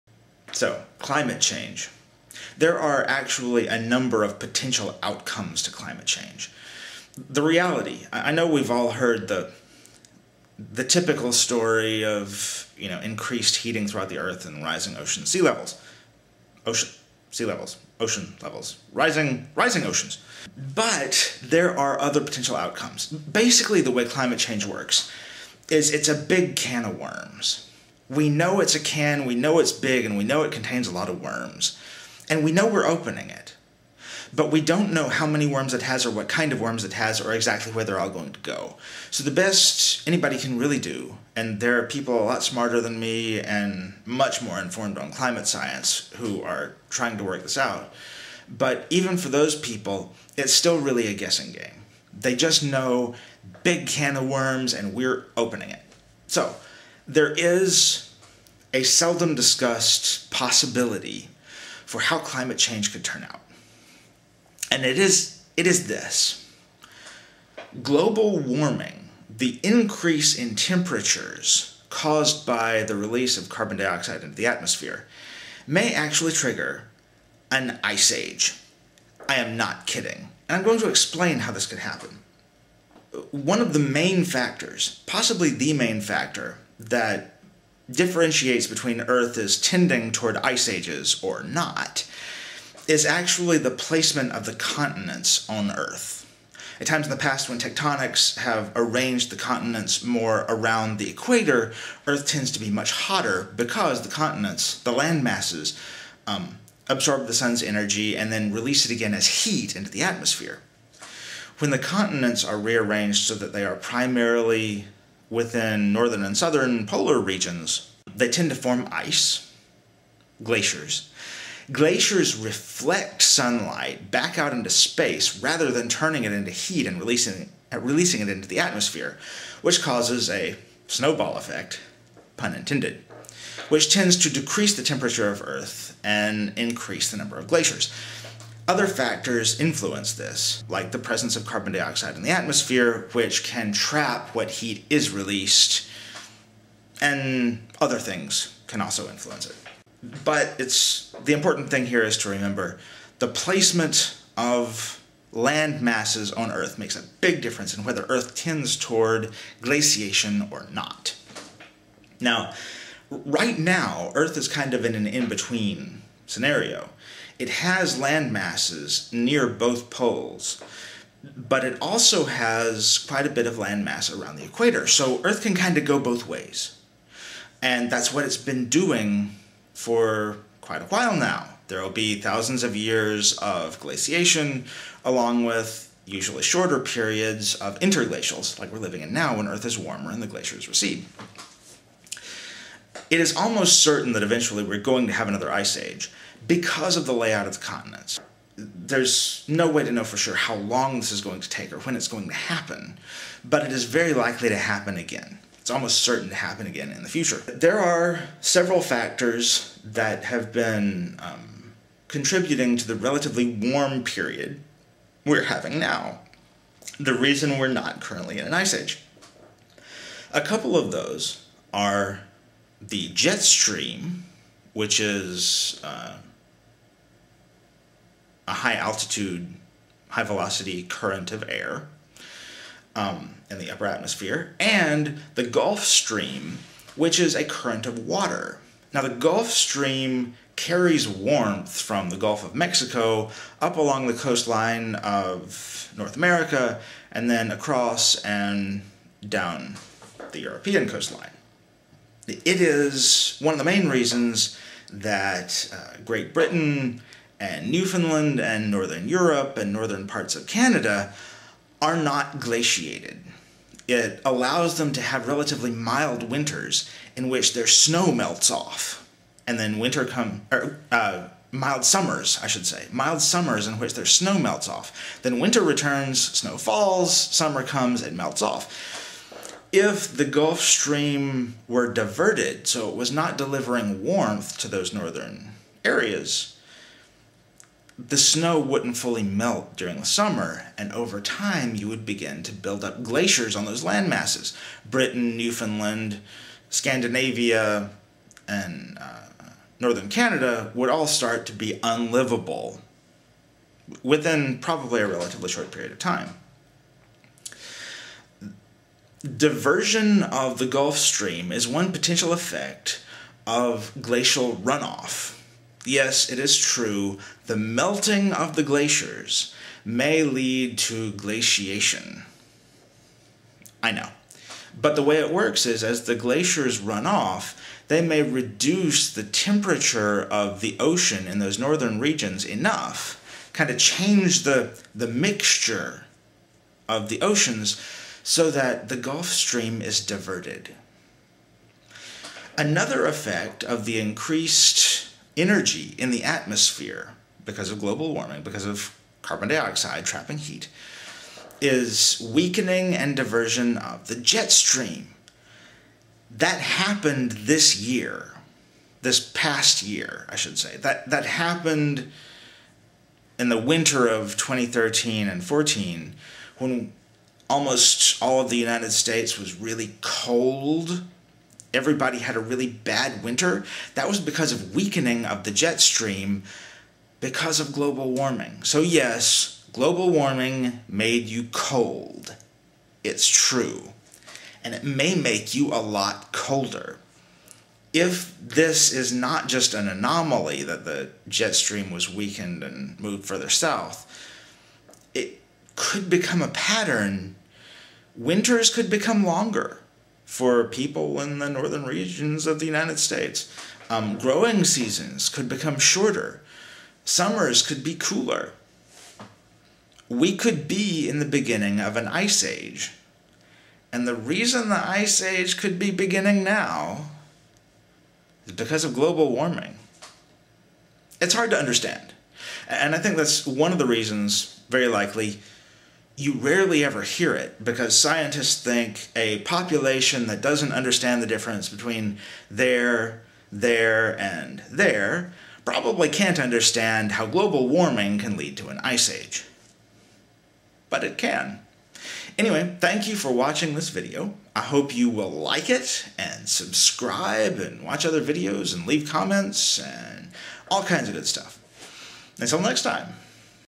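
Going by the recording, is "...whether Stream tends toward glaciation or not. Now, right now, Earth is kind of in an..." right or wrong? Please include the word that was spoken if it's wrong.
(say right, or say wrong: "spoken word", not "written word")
wrong: "Earth", not "Stream".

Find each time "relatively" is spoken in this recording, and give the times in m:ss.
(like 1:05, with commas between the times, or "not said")
3:32, 4:25, 5:05.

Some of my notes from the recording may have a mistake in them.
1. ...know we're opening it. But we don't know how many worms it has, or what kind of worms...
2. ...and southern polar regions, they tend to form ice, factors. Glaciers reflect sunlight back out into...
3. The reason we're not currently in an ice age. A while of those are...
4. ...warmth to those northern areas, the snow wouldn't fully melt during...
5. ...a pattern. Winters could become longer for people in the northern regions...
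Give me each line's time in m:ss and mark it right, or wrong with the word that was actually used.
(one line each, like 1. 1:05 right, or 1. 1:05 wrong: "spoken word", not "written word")
1. 0:32 right
2. 1:56 wrong: "glaciers", not "factors"
3. 3:36 wrong: "couple", not "while"
4. 4:44 right
5. 6:36 right.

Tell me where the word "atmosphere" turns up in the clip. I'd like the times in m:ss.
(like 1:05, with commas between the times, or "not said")
1:14, 1:50, 2:08, 2:22, 3:53, 5:46.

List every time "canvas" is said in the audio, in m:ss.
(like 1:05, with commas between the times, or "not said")
not said.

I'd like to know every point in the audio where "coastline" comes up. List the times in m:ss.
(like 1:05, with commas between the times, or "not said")
4:04, 4:10.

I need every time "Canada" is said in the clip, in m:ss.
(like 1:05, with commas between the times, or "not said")
4:20, 5:00.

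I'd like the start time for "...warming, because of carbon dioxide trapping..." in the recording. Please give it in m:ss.
5:48.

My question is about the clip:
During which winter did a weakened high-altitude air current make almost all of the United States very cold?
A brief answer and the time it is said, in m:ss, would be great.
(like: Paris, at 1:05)
2013-14, at 6:03.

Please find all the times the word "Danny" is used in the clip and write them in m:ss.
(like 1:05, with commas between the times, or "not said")
not said.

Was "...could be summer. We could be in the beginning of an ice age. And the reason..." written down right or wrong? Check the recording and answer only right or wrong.
wrong.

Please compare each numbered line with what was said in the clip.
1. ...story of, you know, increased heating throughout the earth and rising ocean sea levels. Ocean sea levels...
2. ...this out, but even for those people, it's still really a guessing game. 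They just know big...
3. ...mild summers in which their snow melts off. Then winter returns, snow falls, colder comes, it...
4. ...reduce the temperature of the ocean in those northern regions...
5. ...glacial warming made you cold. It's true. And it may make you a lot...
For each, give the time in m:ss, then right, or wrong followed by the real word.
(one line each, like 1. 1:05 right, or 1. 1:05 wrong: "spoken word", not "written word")
1. 0:11 right
2. 0:47 right
3. 4:32 wrong: "summer", not "colder"
4. 5:28 right
5. 6:19 wrong: "global", not "glacial".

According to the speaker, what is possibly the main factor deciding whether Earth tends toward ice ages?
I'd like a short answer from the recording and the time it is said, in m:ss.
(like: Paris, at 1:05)
Placement of the continents, at 1:33.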